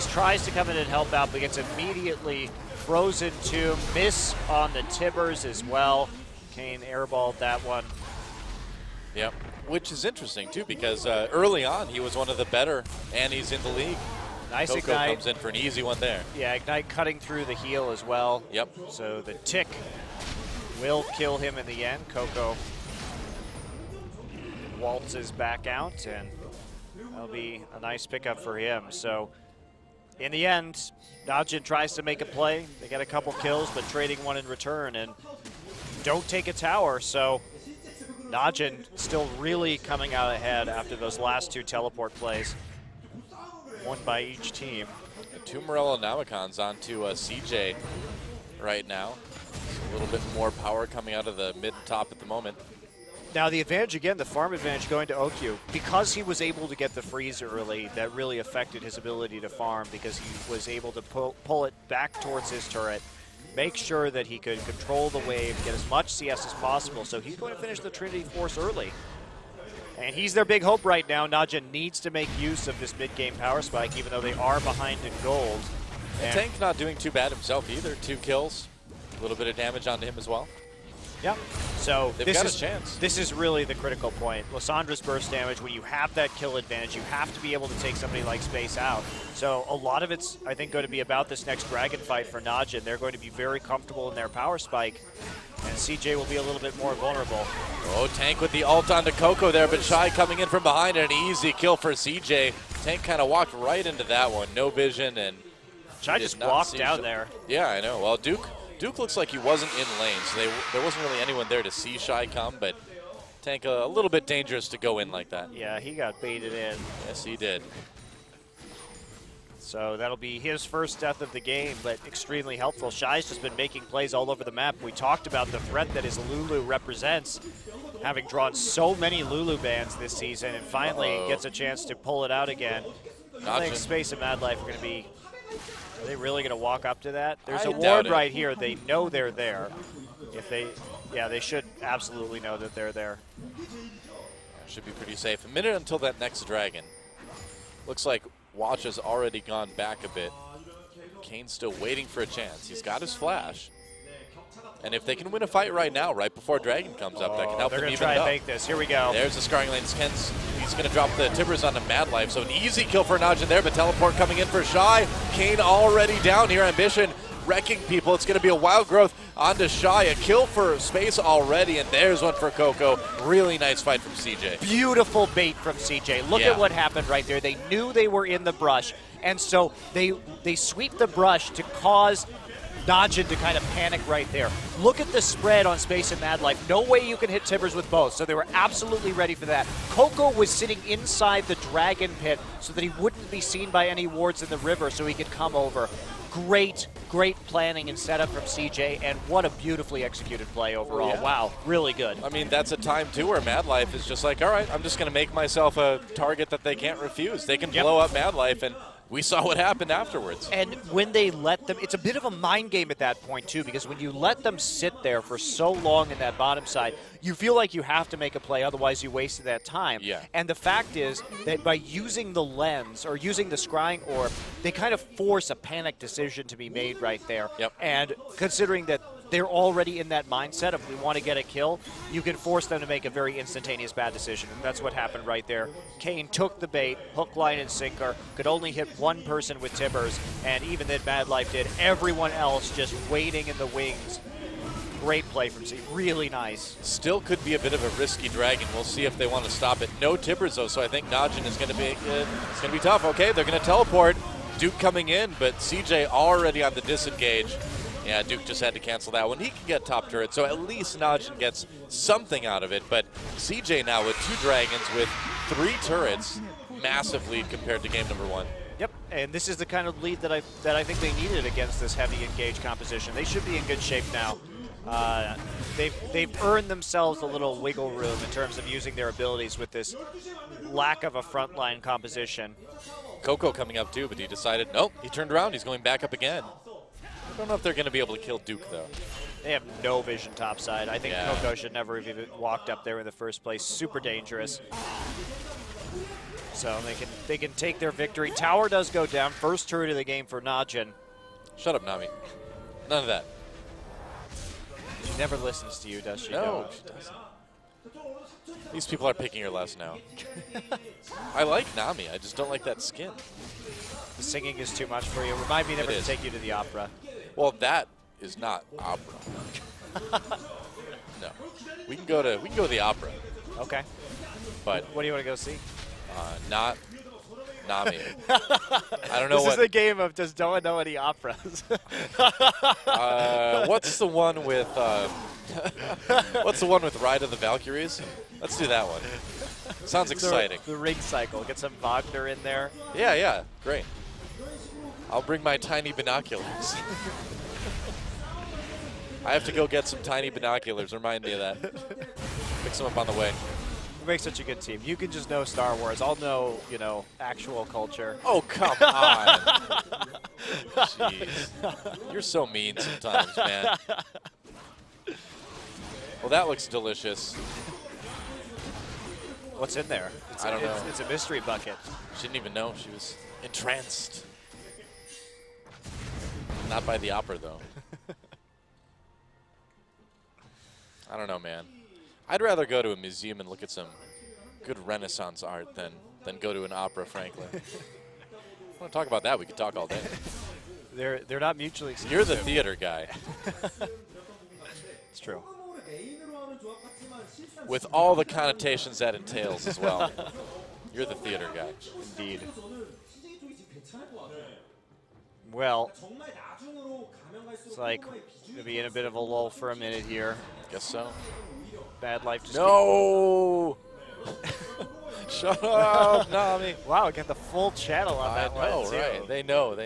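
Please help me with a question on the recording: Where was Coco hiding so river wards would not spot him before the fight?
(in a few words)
Dragon Pit.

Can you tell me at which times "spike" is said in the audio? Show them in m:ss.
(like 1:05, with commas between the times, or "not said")
1:13, 1:34.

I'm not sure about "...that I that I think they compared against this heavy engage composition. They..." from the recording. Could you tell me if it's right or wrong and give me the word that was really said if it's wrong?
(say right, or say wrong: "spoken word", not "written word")
wrong: "needed", not "compared".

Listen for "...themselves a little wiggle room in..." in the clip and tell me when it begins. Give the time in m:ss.
4:36.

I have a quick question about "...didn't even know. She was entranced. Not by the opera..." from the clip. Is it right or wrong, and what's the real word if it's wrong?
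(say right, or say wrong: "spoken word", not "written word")
right.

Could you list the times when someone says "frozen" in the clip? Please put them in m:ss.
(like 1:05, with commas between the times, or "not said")
0:02.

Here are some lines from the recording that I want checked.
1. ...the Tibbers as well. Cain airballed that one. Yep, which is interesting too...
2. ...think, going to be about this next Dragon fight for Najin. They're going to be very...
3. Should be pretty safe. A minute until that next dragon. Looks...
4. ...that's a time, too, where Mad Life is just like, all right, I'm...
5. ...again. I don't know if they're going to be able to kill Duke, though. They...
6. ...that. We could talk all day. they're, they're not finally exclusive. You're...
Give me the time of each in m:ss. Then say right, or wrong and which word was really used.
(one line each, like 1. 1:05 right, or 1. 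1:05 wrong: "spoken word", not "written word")
1. 0:04 right
2. 1:30 right
3. 2:24 right
4. 3:22 right
5. 4:46 right
6. 6:29 wrong: "mutually", not "finally".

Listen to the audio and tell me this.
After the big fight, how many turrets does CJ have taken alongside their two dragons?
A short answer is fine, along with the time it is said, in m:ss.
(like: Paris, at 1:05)
3, at 4:25.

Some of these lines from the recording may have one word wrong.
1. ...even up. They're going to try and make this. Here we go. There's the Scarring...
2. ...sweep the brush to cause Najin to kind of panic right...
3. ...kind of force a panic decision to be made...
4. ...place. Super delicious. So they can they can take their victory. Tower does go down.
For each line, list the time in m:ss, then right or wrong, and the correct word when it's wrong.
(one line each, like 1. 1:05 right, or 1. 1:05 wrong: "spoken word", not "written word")
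1. 2:37 right
2. 3:00 wrong: "Dodging", not "Najin"
3. 3:44 right
4. 4:53 wrong: "dangerous", not "delicious".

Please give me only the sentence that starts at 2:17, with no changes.
There's I a ward right here.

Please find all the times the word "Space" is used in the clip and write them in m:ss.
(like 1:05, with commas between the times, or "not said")
1:28, 2:13, 2:50, 3:05.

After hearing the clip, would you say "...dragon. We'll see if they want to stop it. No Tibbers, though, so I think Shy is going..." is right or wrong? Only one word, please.
wrong.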